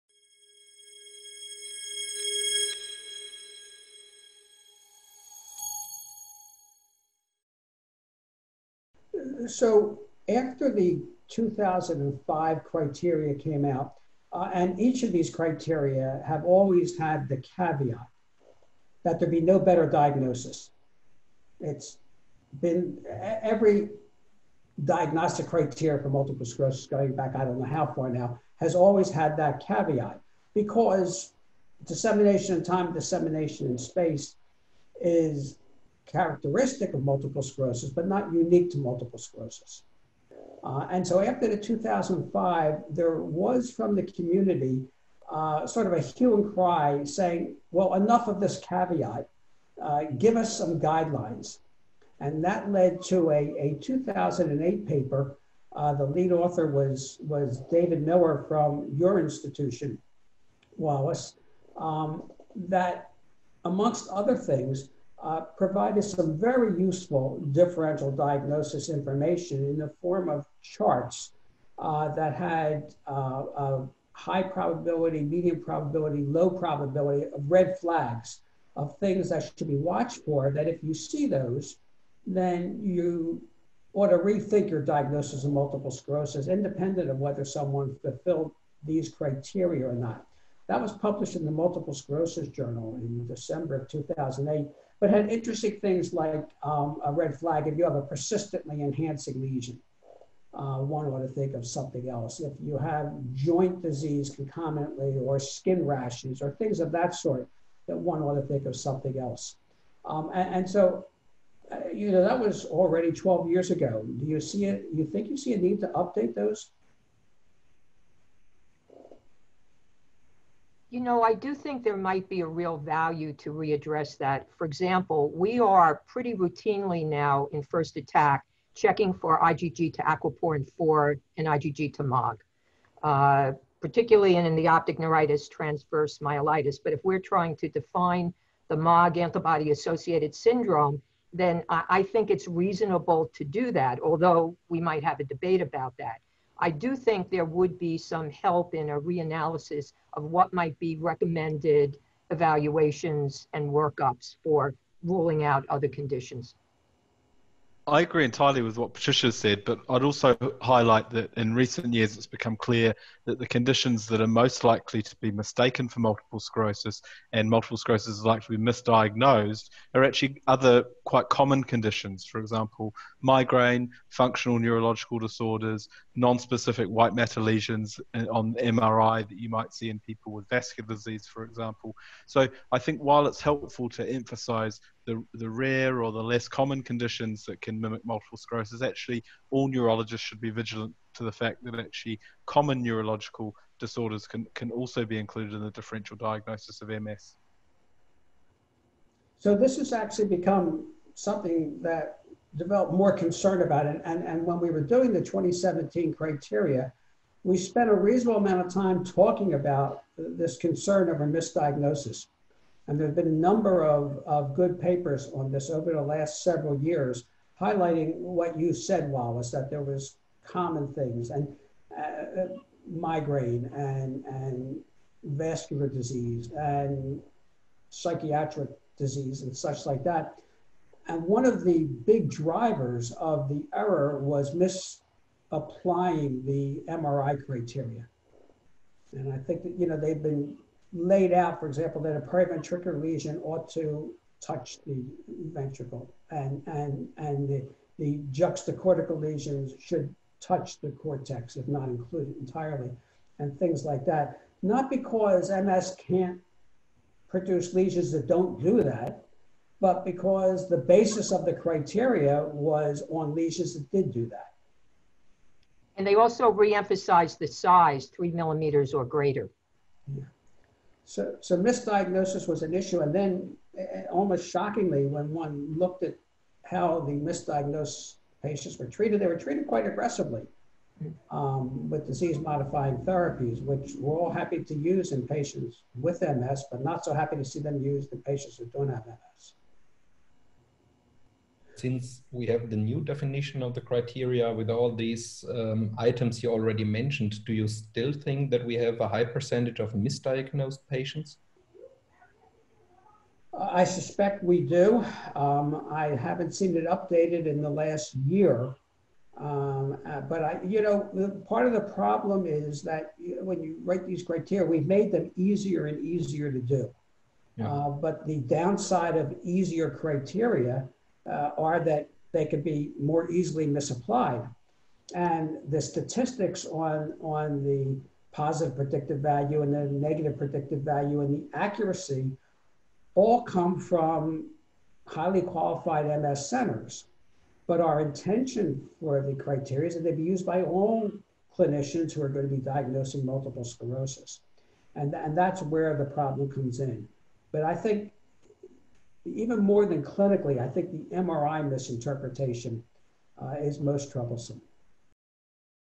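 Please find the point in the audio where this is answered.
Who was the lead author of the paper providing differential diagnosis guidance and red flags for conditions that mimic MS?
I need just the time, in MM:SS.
00:57.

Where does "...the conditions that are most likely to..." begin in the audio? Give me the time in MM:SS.
02:43.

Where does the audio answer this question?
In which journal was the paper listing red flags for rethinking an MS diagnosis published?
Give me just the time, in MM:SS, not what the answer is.
01:31.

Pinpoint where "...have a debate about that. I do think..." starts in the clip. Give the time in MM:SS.
02:25.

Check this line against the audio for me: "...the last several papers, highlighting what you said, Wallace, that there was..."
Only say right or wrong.
wrong.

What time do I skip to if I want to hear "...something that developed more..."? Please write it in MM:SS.
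03:21.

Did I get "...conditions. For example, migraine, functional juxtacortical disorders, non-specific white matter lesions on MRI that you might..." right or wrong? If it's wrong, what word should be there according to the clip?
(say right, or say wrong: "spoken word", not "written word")
wrong: "neurological", not "juxtacortical".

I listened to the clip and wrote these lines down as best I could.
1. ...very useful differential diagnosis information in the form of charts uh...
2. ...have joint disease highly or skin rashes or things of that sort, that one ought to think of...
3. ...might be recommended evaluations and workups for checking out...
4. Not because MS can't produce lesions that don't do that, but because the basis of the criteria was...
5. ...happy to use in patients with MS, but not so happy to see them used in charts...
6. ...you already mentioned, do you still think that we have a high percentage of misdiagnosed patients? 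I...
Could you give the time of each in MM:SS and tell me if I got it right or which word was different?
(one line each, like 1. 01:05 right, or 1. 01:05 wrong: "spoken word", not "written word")
1. 01:06 right
2. 01:42 wrong: "concomitantly", not "highly"
3. 02:30 wrong: "ruling", not "checking"
4. 04:14 right
5. 04:44 wrong: "patients", not "charts"
6. 04:56 right.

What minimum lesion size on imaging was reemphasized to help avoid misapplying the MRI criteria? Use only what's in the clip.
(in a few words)
3 millimeters.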